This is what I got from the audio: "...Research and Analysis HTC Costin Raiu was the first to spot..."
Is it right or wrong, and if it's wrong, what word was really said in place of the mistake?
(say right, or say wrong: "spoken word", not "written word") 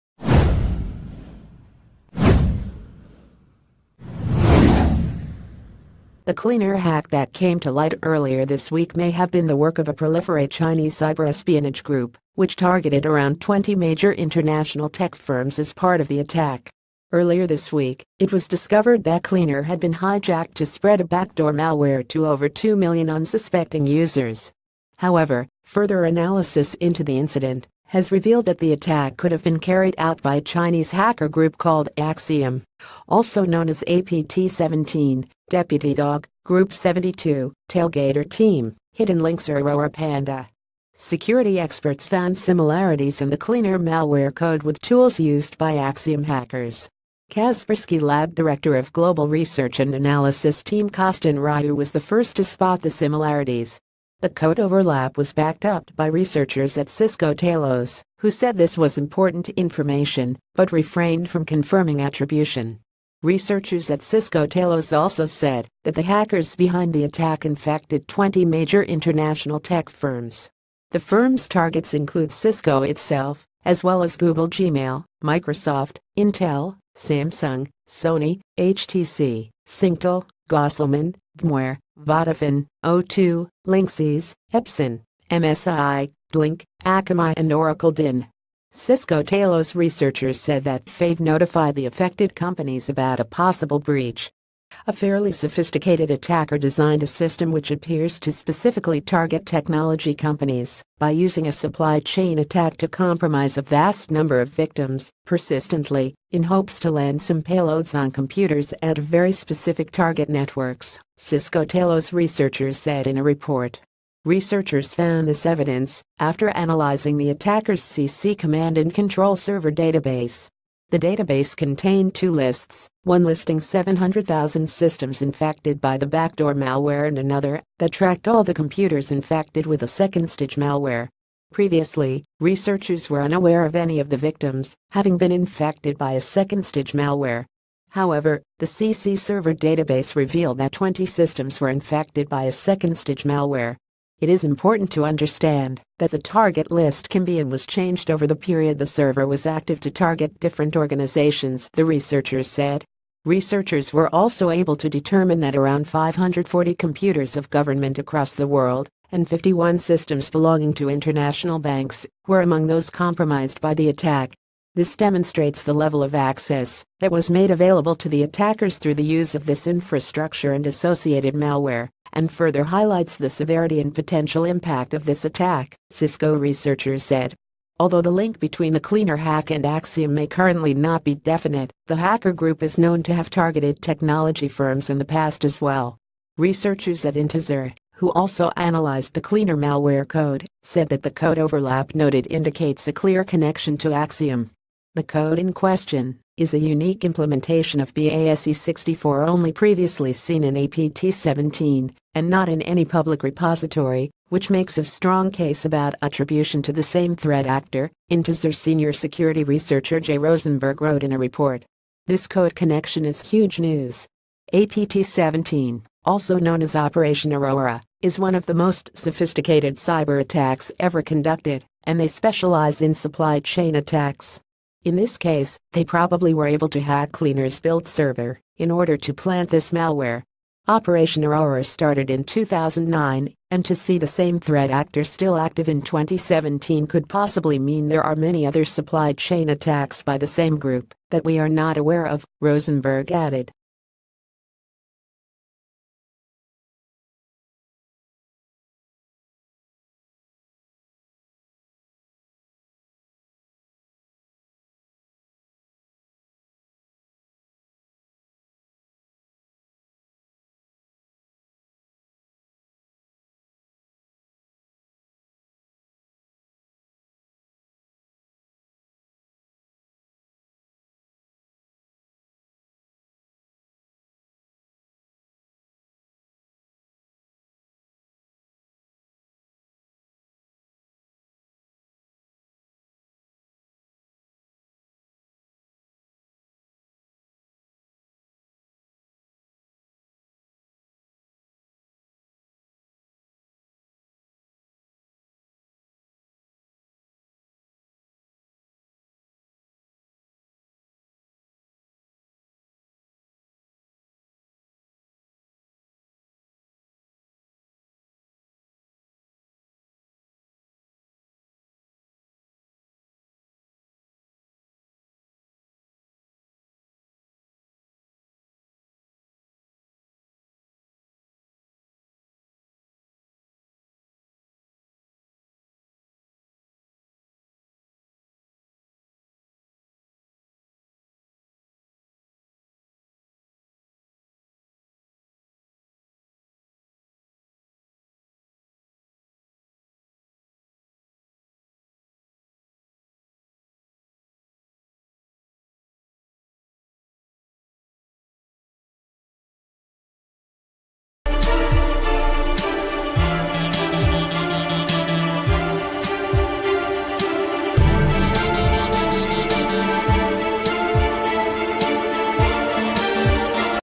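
wrong: "Team", not "HTC".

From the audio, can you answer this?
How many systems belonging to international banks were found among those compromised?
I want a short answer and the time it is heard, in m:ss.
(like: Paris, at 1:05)
51, at 2:39.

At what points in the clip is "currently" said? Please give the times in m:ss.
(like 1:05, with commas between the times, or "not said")
3:00.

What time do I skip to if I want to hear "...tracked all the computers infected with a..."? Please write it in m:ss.
2:07.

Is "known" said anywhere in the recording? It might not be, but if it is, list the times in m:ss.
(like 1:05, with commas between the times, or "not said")
0:33, 3:02, 3:36.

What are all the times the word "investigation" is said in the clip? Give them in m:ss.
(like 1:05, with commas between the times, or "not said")
not said.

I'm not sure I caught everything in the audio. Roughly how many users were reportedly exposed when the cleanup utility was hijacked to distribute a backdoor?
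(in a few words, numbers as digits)
over 2 million.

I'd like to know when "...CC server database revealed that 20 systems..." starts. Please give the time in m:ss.
2:18.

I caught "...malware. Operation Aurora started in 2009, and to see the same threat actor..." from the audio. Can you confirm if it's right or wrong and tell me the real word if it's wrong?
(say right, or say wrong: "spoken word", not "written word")
right.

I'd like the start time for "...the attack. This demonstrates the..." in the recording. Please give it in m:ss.
2:43.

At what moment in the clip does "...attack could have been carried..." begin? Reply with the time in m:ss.
0:28.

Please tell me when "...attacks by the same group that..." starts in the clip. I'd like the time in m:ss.
3:59.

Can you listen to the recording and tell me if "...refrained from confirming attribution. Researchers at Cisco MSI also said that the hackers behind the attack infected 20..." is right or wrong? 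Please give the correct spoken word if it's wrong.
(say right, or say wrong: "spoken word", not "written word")
wrong: "Talos", not "MSI".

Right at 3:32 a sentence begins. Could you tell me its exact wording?
This code connection is huge news.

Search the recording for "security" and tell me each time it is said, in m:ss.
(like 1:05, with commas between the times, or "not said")
0:40, 3:28.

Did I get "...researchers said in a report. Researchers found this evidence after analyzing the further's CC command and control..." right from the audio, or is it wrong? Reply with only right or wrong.
wrong.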